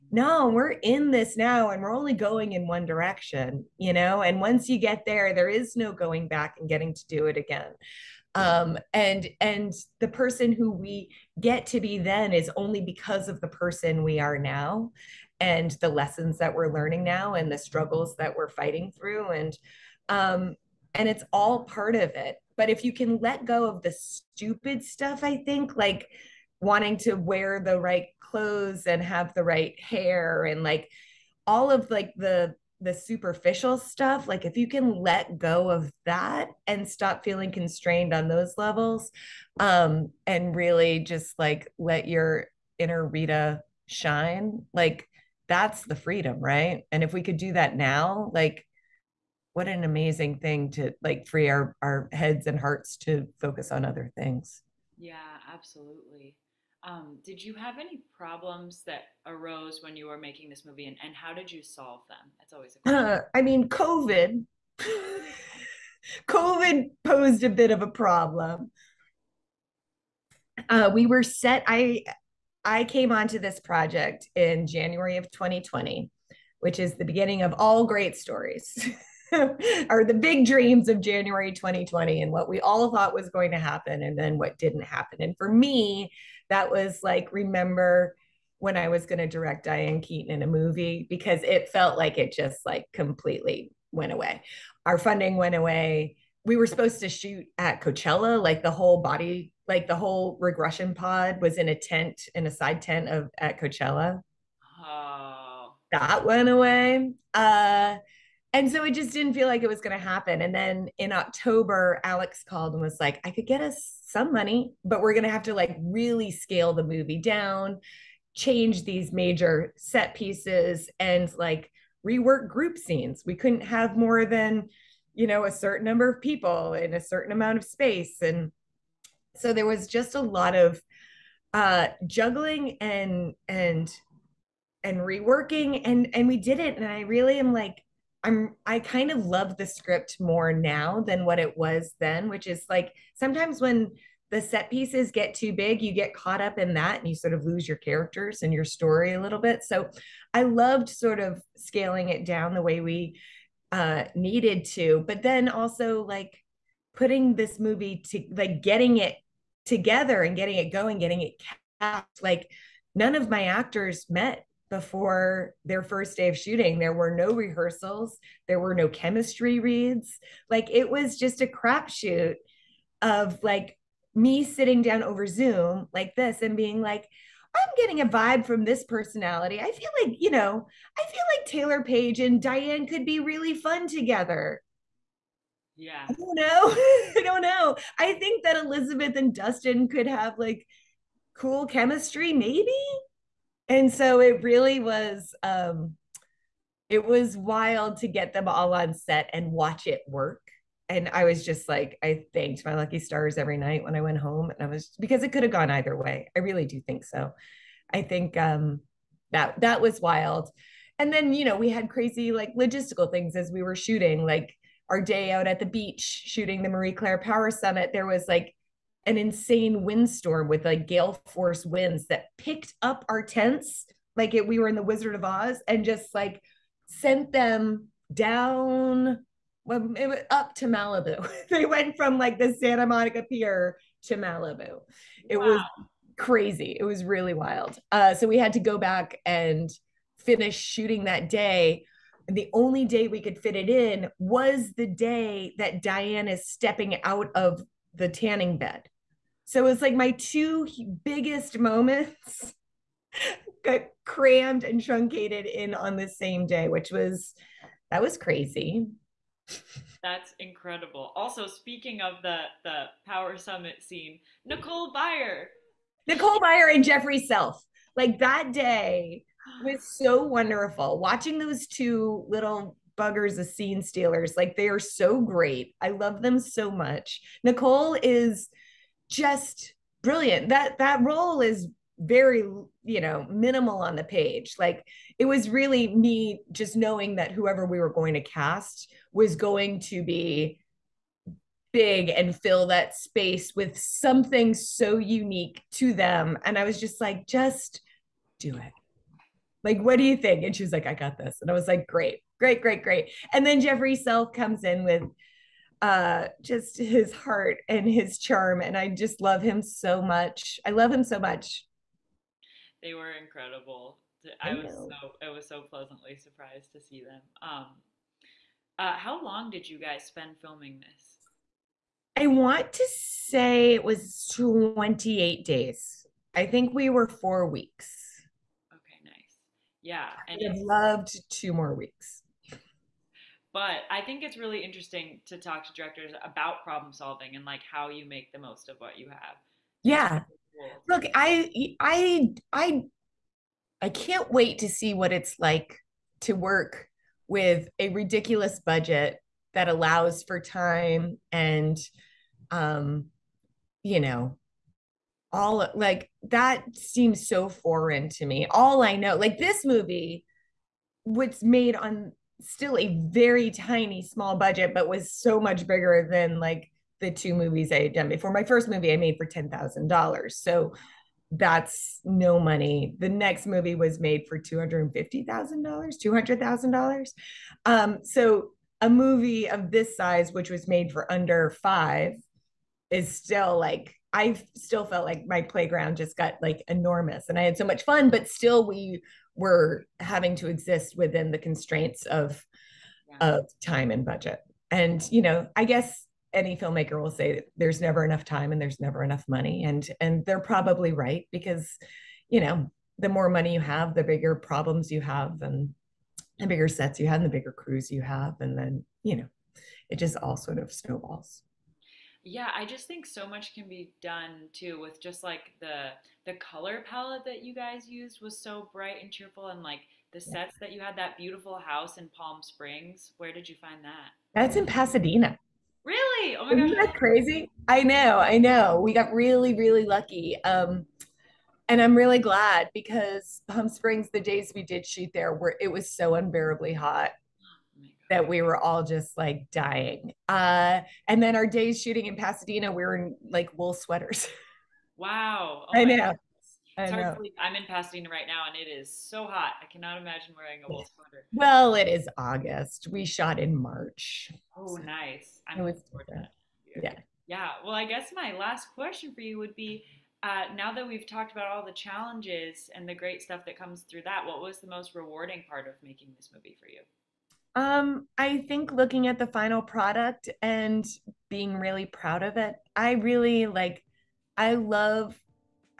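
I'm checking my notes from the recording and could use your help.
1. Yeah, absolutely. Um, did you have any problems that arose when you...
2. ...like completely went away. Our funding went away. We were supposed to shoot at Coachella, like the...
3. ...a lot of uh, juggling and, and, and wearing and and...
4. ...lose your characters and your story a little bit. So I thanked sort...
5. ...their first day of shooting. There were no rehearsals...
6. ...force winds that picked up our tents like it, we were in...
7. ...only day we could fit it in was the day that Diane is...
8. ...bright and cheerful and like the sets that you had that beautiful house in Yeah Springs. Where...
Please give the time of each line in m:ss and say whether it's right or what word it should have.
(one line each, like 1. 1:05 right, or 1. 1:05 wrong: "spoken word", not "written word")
1. 0:54 right
2. 1:32 right
3. 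2:10 wrong: "reworking", not "wearing"
4. 2:27 wrong: "loved", not "thanked"
5. 2:45 right
6. 3:41 right
7. 4:02 right
8. 6:58 wrong: "Palm", not "Yeah".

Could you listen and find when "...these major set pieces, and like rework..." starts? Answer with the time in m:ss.
1:58.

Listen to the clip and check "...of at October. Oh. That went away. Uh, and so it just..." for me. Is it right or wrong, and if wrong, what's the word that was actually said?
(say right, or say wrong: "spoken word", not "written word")
wrong: "Coachella", not "October".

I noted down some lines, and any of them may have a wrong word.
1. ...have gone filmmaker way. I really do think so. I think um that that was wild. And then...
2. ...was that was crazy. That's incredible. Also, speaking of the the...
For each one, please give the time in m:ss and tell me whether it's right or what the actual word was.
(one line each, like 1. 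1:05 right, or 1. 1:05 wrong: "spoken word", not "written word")
1. 3:25 wrong: "either", not "filmmaker"
2. 4:16 right.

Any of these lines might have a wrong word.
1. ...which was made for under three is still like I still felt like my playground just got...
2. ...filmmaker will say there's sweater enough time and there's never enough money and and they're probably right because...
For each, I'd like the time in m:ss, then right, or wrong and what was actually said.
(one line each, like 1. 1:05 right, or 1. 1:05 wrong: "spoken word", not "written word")
1. 6:20 wrong: "five", not "three"
2. 6:36 wrong: "never", not "sweater".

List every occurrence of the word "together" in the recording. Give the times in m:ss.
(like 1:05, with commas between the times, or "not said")
2:39, 3:03.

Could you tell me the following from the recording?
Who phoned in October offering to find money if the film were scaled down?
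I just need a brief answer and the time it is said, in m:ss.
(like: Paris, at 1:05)
Alex, at 1:52.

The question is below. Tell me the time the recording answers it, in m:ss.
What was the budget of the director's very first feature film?
6:09.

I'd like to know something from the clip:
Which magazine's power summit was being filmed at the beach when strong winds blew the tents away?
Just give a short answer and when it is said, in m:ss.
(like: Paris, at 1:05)
Marie Claire, at 3:36.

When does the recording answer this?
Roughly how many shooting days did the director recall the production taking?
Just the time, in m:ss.
5:24.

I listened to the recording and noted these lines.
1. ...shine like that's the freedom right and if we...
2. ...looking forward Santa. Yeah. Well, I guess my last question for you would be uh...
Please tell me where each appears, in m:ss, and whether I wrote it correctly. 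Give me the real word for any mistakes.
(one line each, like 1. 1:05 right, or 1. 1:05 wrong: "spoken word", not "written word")
1. 0:43 right
2. 7:35 wrong: "Yeah", not "Santa".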